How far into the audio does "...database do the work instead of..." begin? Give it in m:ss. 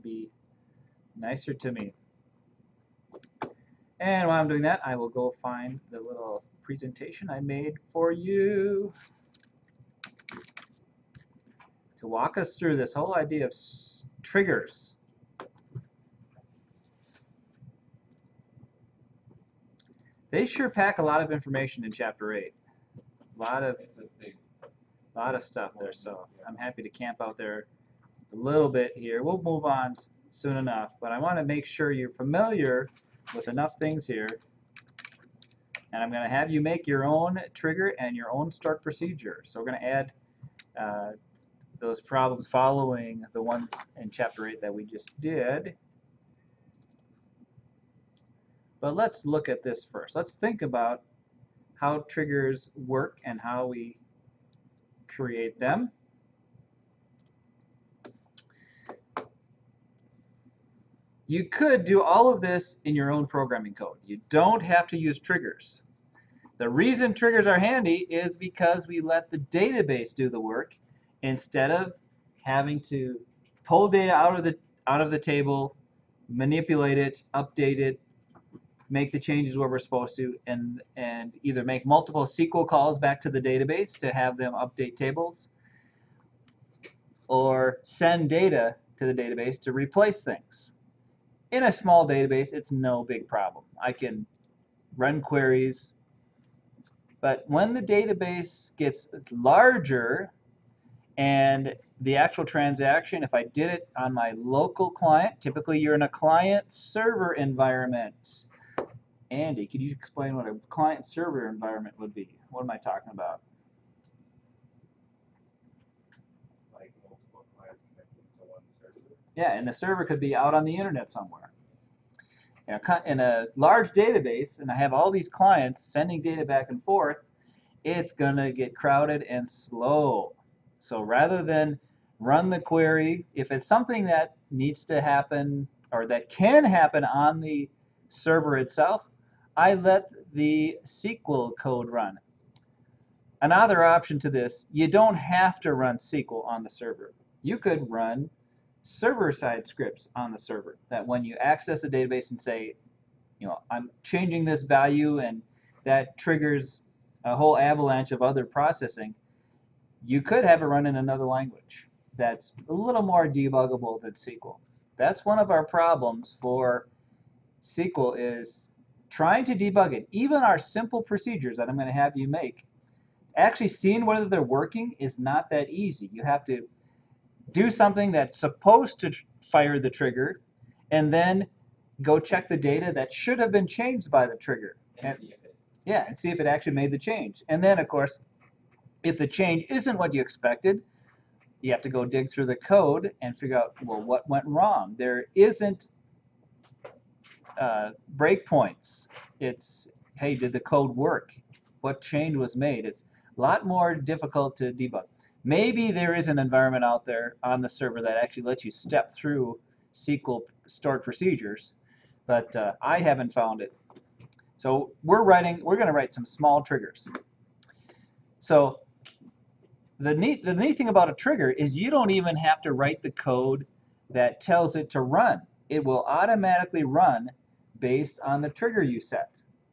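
1:09.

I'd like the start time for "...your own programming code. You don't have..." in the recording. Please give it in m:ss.
1:02.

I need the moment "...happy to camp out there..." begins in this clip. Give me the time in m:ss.
0:26.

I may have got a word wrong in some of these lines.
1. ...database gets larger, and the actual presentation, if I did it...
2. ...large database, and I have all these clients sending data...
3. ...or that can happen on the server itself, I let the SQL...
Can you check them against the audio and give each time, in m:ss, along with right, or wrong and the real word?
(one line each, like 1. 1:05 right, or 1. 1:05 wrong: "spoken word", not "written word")
1. 1:37 wrong: "transaction", not "presentation"
2. 2:03 right
3. 2:15 right.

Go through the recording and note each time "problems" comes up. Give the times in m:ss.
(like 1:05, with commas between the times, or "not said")
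0:42, 1:33, 2:45.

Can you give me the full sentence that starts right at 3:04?
And, yeah, and see if it actually made the change.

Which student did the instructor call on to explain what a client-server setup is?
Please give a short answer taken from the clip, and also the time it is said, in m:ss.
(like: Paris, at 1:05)
Andy, at 1:49.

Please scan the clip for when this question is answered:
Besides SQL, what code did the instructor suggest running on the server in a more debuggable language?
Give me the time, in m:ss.
2:28.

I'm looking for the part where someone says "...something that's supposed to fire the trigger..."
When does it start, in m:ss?
2:57.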